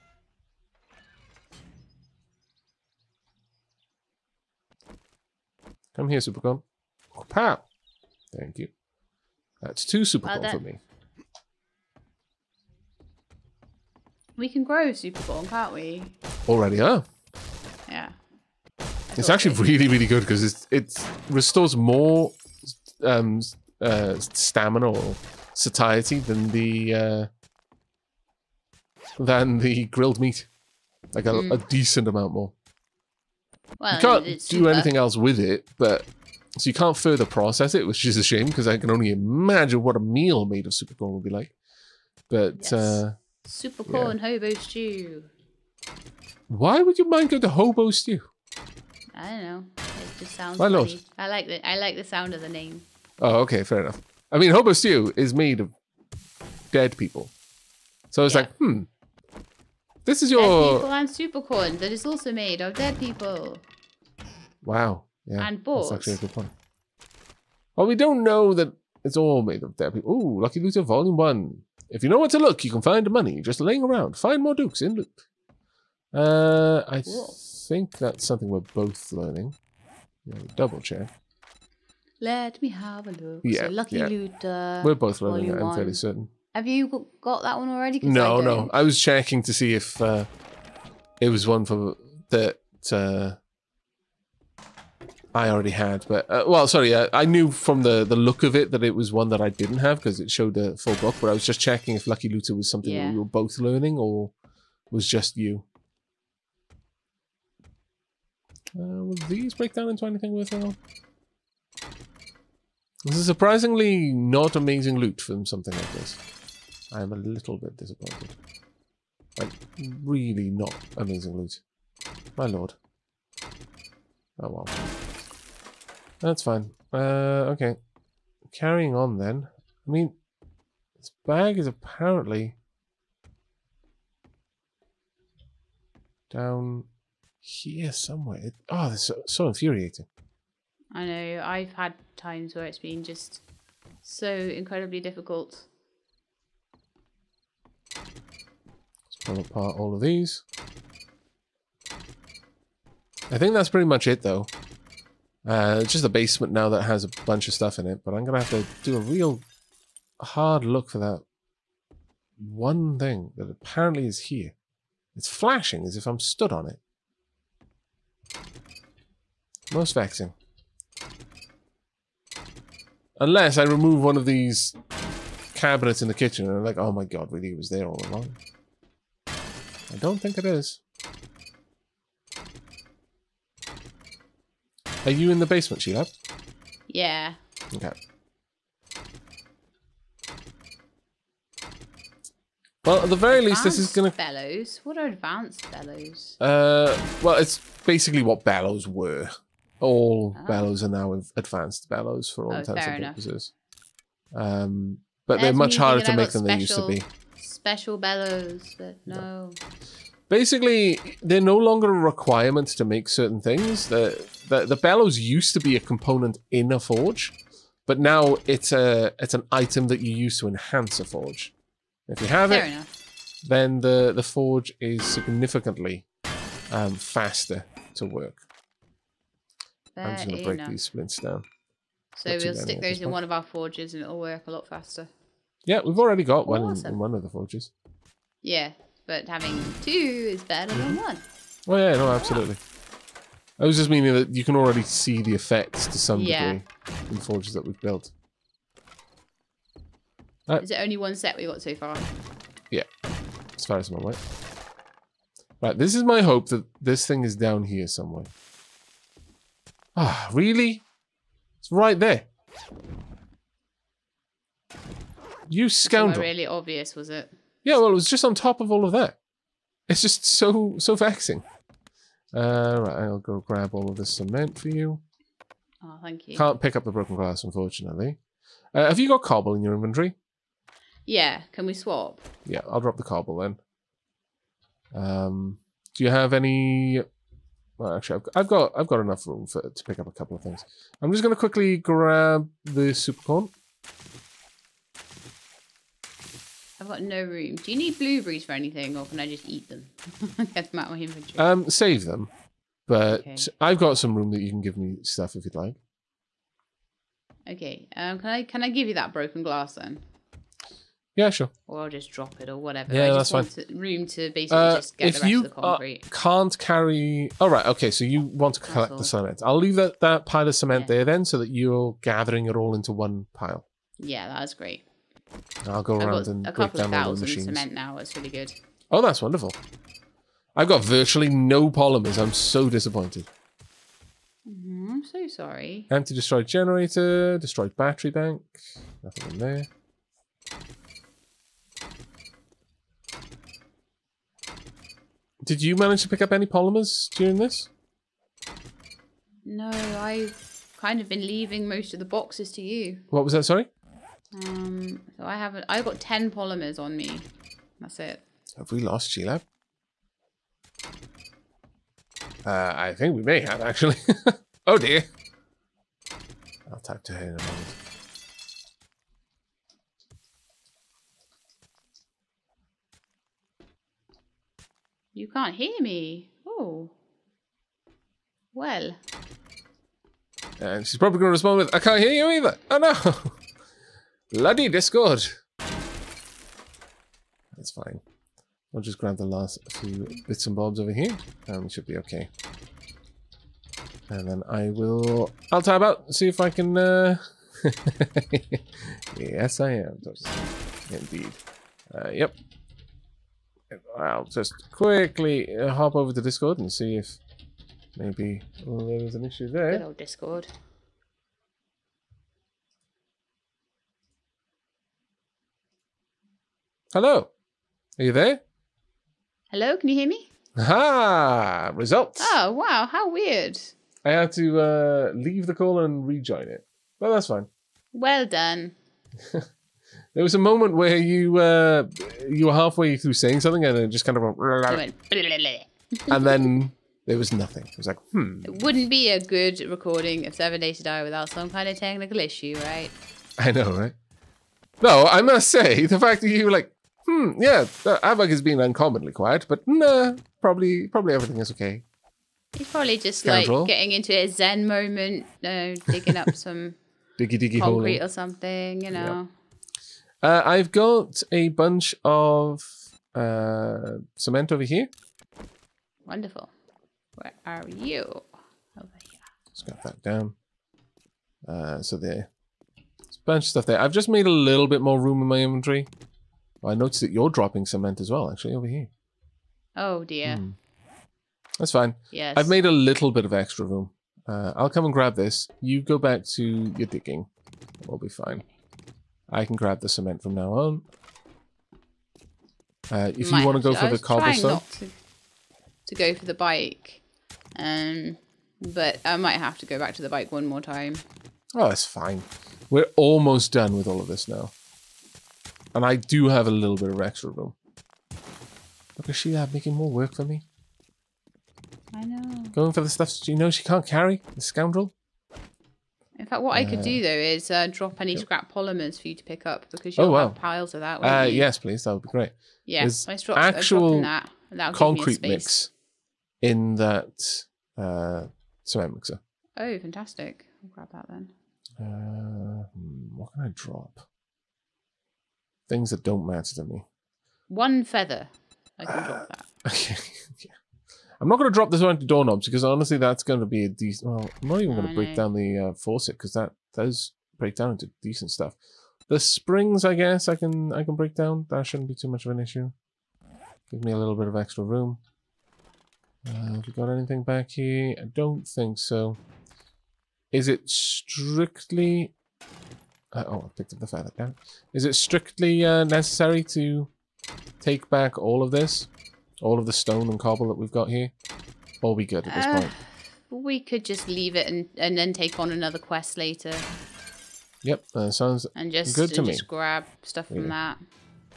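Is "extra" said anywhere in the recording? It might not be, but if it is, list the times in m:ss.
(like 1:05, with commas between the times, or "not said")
8:03, 8:27, 9:14.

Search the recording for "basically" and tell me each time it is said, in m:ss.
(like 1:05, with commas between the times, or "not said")
3:17, 3:30, 5:14.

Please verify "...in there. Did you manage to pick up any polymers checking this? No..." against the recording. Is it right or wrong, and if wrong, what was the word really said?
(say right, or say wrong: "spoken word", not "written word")
wrong: "during", not "checking".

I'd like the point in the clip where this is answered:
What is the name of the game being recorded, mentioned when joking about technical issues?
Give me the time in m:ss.
7:20.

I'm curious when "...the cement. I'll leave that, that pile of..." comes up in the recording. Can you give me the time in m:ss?
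5:18.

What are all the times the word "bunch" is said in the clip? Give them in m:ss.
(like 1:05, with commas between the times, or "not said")
2:37, 7:41, 7:53.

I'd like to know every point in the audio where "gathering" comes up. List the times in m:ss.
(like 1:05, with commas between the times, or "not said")
5:22.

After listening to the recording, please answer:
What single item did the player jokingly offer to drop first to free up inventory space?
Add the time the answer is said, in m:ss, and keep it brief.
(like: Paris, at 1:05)
One feather, at 8:57.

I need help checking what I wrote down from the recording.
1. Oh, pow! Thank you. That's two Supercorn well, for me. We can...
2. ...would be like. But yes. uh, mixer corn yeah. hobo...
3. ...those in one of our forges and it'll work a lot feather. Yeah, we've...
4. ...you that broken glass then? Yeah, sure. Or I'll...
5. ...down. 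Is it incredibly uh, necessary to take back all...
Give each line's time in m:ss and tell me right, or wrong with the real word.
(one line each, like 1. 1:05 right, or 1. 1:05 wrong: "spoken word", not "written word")
1. 0:07 right
2. 0:41 wrong: "super", not "mixer"
3. 3:52 wrong: "faster", not "feather"
4. 5:08 right
5. 9:24 wrong: "strictly", not "incredibly".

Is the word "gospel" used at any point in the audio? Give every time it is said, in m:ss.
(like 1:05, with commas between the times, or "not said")
not said.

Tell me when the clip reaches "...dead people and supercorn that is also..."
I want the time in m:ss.
1:00.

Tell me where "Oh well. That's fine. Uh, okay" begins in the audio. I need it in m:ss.
2:04.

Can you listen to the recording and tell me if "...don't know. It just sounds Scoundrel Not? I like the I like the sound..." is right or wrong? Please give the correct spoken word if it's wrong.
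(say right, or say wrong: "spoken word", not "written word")
wrong: "Why", not "Scoundrel".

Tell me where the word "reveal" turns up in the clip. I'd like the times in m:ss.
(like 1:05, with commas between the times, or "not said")
not said.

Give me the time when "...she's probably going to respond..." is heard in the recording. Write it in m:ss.
6:20.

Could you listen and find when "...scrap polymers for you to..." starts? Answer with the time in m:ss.
8:38.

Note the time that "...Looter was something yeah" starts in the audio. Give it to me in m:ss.
1:42.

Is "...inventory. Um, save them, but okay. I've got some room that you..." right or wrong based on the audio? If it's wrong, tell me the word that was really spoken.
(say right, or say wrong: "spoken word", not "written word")
right.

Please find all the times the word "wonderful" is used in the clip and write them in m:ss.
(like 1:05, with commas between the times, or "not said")
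5:29, 7:46.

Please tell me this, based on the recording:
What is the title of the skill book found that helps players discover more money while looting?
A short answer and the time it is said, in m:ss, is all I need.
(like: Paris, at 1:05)
Lucky Looter Volume One, at 1:10.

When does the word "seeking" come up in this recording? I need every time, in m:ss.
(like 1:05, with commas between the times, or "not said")
not said.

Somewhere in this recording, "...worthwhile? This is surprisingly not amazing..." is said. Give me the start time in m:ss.
1:50.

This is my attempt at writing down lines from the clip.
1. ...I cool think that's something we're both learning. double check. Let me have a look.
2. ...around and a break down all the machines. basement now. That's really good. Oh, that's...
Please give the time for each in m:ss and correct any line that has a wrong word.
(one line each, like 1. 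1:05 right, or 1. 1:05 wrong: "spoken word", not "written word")
1. 1:16 right
2. 5:26 wrong: "cement", not "basement".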